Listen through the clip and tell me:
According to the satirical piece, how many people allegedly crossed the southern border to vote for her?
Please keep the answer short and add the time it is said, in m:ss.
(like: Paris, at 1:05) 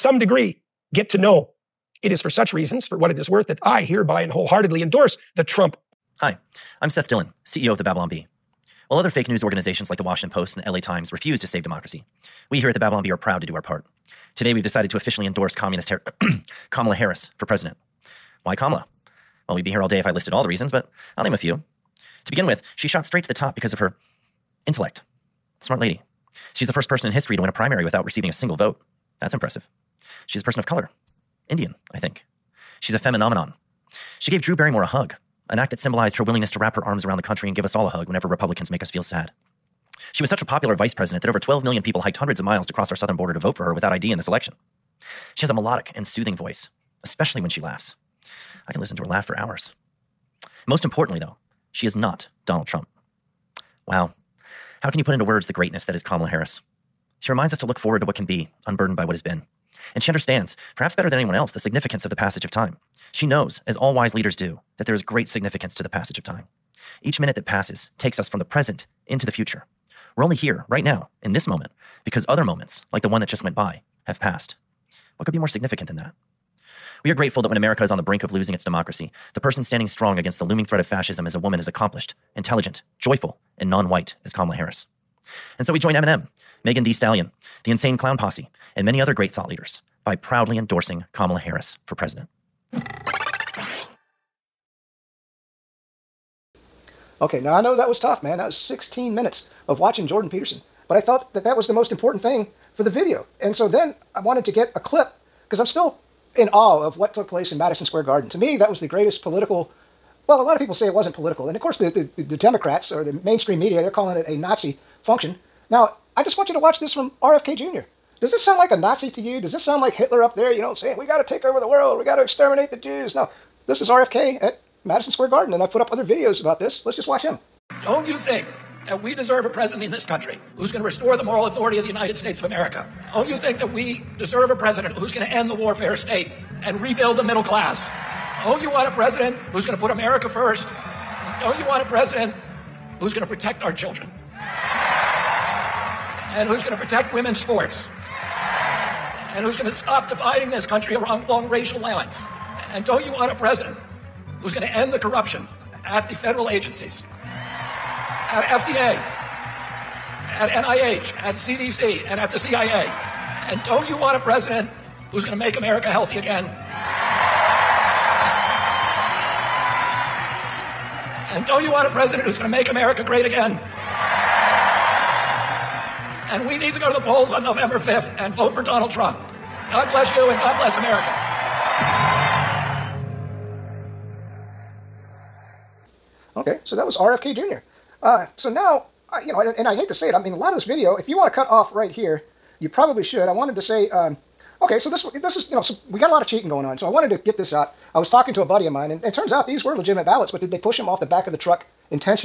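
12 million, at 0:41.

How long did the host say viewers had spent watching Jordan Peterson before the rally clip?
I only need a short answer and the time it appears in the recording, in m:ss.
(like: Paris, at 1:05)
16 minutes, at 1:38.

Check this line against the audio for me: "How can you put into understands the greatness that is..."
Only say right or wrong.
wrong.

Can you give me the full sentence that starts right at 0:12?
We here at the Babylon Bee are proud to do our part.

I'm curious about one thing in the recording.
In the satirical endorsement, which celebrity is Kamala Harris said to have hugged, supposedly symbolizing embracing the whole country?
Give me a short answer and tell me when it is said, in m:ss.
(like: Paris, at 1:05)
Drew Barrymore, at 0:34.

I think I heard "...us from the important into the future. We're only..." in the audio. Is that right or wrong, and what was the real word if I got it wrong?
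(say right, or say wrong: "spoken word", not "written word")
wrong: "present", not "important".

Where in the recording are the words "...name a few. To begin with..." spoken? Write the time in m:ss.
0:21.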